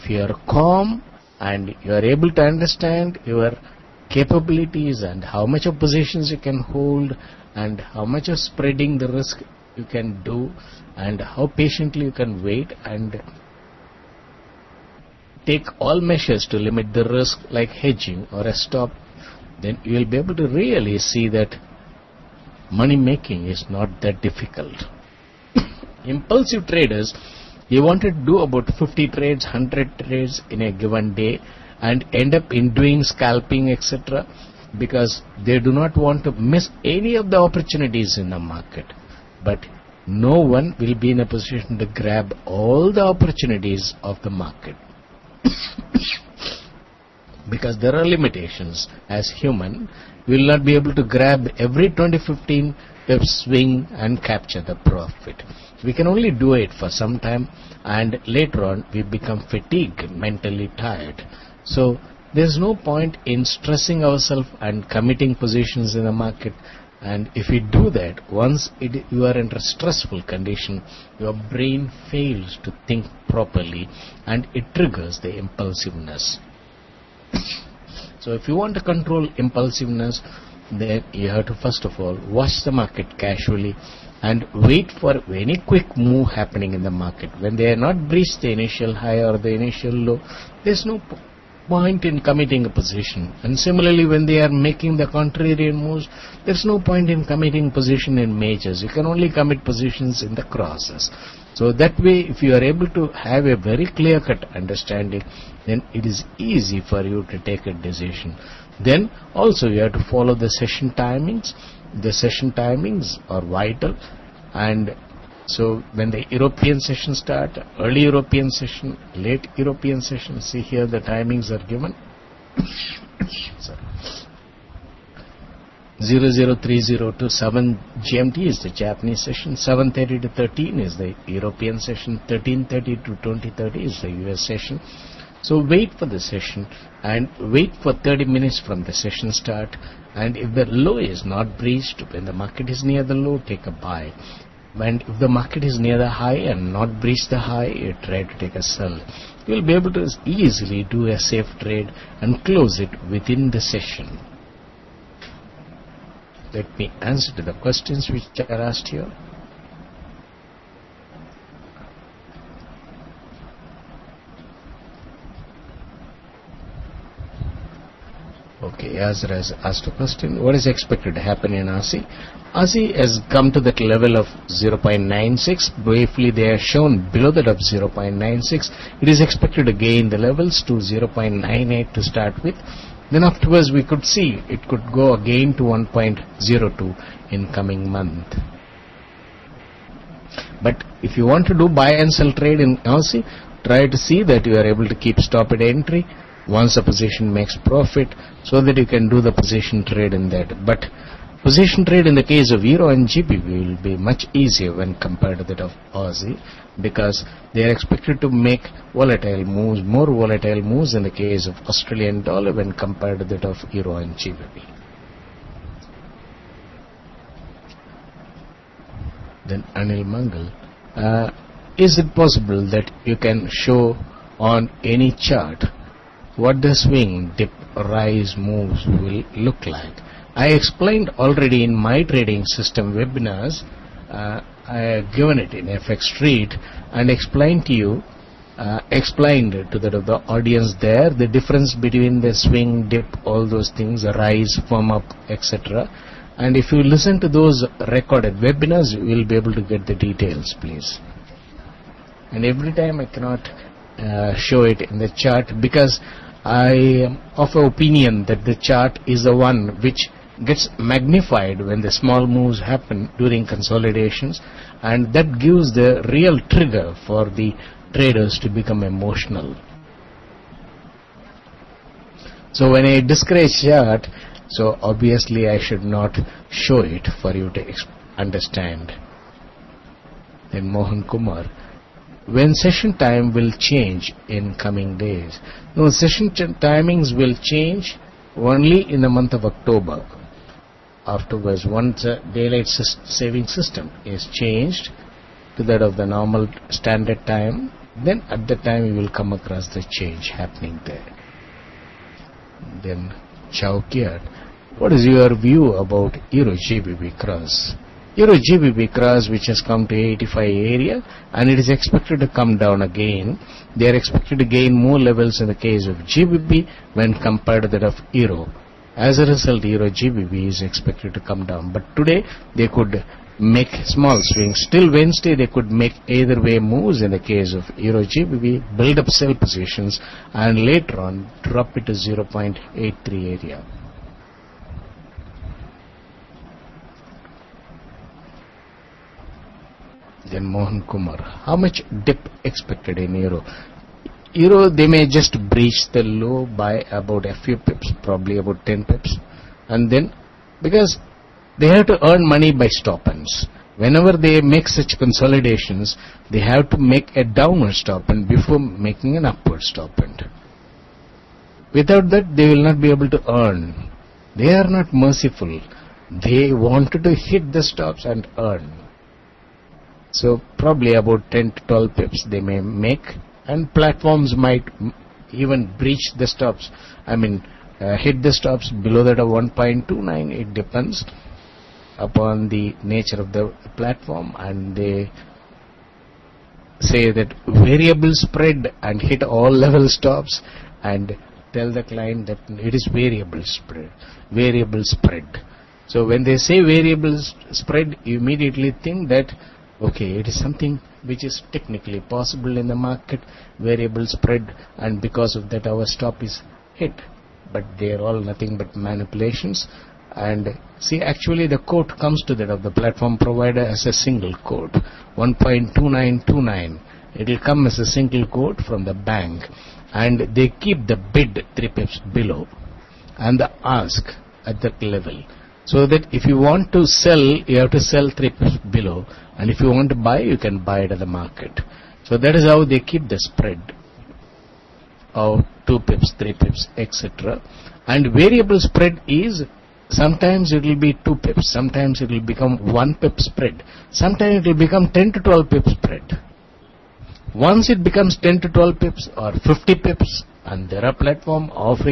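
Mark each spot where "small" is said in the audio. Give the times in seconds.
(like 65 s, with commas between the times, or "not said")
261 s, 323 s.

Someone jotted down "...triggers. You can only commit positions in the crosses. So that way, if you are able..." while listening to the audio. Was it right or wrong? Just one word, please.
wrong.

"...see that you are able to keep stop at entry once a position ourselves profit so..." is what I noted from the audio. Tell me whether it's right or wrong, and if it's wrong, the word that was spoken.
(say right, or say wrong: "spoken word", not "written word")
wrong: "makes", not "ourselves".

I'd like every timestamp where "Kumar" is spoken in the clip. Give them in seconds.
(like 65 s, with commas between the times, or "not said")
281 s, 340 s.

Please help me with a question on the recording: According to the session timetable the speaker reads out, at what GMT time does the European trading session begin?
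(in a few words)
7:30.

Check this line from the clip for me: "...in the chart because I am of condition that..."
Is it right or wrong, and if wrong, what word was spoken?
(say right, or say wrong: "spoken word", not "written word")
wrong: "opinion", not "condition".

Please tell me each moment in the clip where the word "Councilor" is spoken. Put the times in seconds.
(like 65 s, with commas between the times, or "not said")
not said.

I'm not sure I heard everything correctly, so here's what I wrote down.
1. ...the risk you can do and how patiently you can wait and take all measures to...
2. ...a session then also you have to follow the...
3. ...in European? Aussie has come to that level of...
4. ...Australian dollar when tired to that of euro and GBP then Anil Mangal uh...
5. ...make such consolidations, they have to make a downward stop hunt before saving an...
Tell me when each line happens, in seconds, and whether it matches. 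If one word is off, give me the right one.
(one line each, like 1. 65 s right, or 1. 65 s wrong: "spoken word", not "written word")
1. 8 s right
2. 107 s wrong: "decision", not "session"
3. 171 s wrong: "Aussie", not "European"
4. 211 s wrong: "compared", not "tired"
5. 354 s wrong: "making", not "saving".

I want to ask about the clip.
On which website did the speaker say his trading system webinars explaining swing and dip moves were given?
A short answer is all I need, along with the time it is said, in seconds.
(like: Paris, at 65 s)
FX Street, at 235 s.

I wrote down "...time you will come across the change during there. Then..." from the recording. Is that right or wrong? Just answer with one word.
wrong.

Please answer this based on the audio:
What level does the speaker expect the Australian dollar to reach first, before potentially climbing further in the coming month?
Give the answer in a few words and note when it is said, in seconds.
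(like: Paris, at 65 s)
0.98, at 180 s.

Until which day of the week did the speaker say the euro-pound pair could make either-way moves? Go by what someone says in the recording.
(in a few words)
Wednesday.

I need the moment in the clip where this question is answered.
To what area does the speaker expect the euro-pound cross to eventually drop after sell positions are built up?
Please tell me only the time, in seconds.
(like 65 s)
331 s.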